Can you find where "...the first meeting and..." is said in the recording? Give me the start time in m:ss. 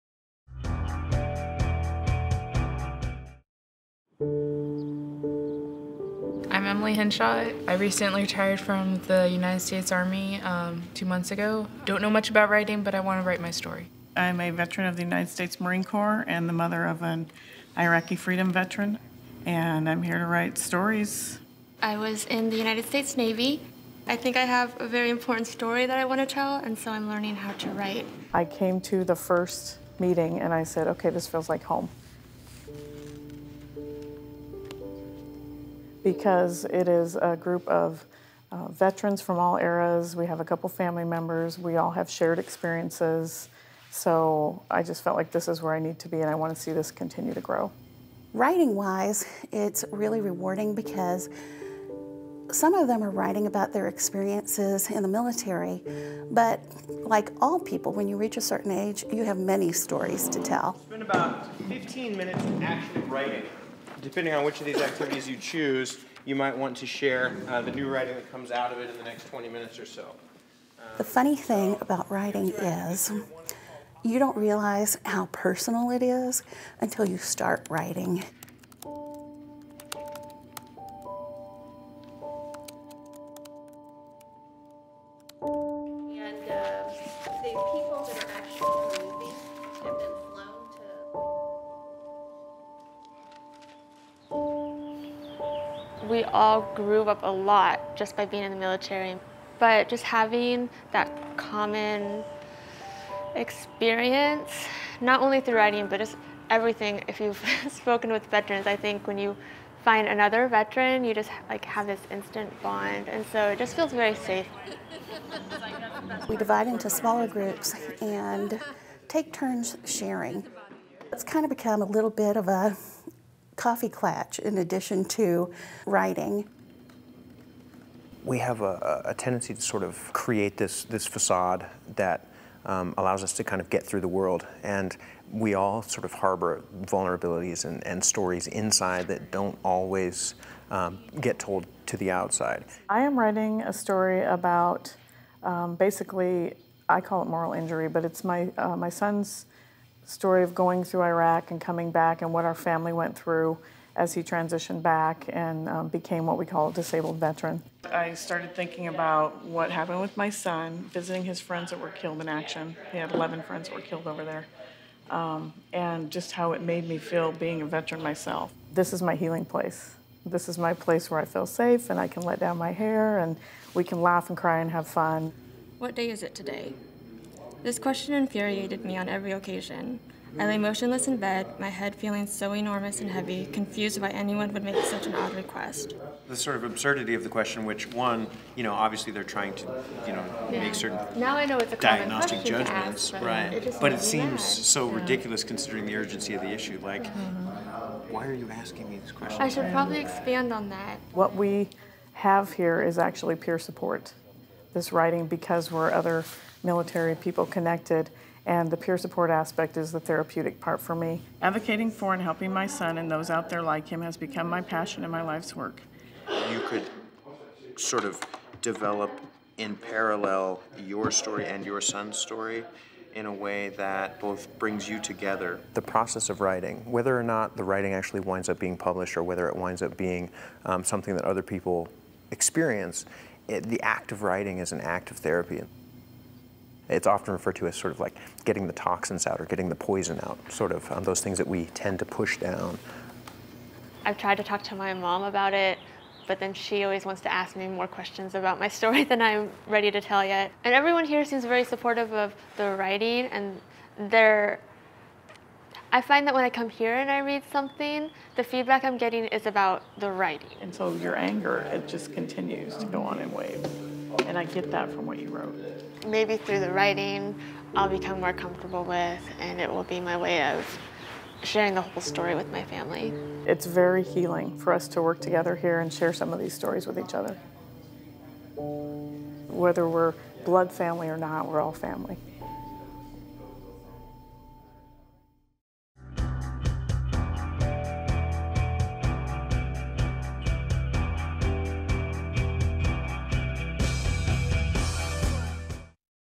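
0:29.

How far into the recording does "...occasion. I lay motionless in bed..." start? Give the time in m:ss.
2:59.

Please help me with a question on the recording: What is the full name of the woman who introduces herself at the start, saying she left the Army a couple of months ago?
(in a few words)
Emily Henshaw.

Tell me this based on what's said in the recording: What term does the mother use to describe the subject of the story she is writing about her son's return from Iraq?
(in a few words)
moral injury.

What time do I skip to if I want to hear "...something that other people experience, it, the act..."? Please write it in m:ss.
3:50.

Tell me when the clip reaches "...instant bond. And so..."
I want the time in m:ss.
1:52.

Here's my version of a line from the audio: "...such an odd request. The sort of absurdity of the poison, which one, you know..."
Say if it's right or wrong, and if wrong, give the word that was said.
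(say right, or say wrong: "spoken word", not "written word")
wrong: "question", not "poison".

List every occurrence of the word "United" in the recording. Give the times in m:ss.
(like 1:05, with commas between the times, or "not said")
0:09, 0:15, 0:22.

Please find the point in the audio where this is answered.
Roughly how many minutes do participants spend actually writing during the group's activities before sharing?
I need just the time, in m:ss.
1:01.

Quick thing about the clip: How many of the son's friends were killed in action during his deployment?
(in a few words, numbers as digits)
11.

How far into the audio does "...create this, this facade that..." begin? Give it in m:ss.
2:10.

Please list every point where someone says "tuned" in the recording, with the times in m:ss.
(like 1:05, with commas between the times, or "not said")
not said.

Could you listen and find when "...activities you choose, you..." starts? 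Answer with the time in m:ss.
1:04.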